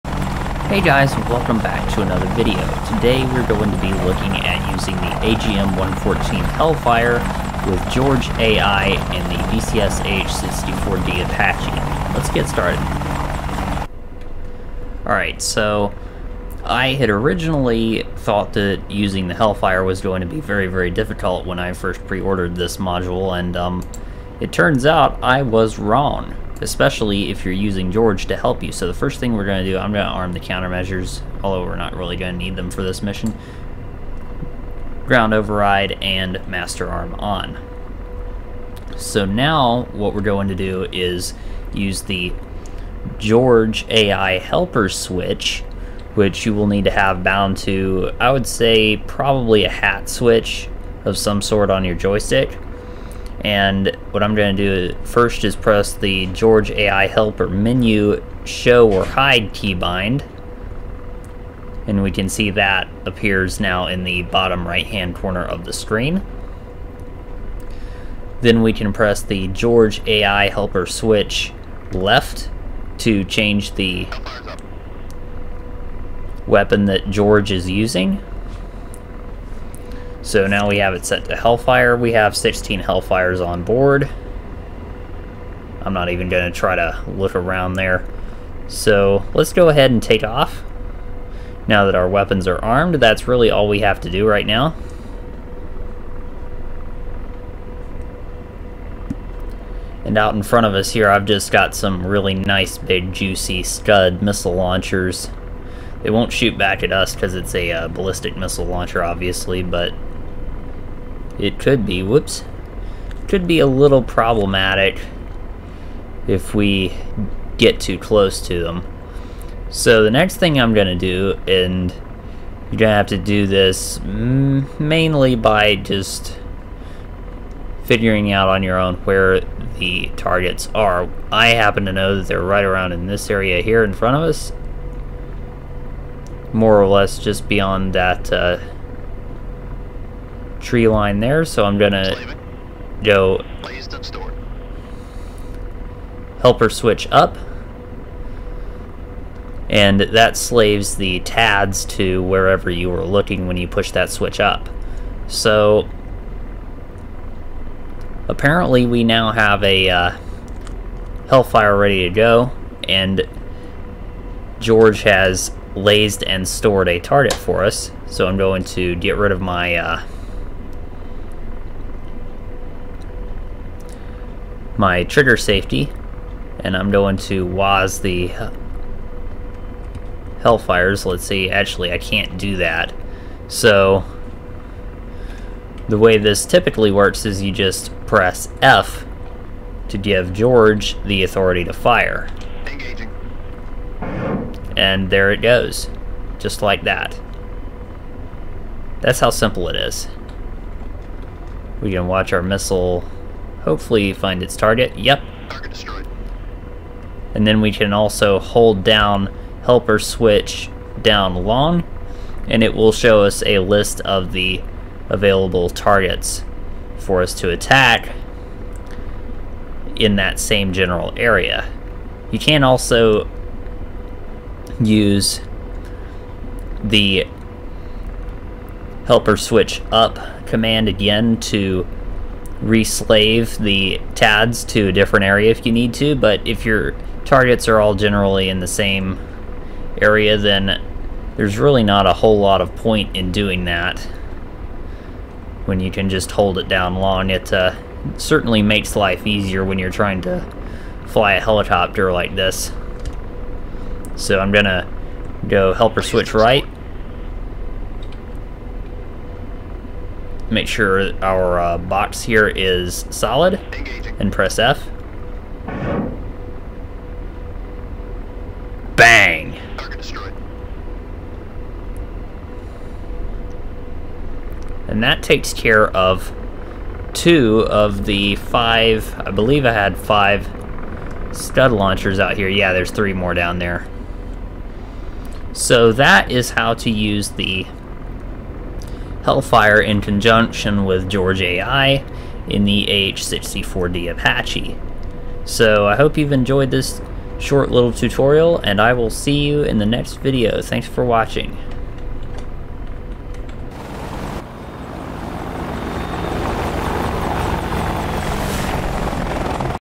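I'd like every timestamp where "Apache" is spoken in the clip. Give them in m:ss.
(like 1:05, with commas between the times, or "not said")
0:11, 4:54.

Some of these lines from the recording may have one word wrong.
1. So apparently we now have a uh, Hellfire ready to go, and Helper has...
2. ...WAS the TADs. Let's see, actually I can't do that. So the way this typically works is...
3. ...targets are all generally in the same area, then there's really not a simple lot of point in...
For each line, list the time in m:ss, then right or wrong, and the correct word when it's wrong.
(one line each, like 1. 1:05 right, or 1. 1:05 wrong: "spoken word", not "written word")
1. 2:35 wrong: "George", not "Helper"
2. 2:57 wrong: "Hellfires", not "TADs"
3. 3:57 wrong: "whole", not "simple".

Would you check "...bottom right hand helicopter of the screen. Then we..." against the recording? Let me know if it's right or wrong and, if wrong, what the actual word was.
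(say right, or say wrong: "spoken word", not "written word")
wrong: "corner", not "helicopter".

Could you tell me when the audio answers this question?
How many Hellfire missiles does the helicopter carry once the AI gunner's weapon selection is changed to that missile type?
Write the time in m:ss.
1:22.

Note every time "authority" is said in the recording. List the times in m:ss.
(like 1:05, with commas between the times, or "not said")
3:11.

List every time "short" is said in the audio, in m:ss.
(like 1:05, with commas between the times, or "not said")
4:57.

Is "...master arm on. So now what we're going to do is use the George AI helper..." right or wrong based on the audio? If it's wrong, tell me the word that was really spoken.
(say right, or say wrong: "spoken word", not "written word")
right.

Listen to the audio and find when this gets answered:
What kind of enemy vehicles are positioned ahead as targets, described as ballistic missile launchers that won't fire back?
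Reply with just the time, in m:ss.
1:43.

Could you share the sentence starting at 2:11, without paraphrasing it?
I happen to know that they're right around in this area here in front of us.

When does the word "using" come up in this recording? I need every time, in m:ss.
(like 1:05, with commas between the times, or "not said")
0:04, 0:18, 0:27, 1:17.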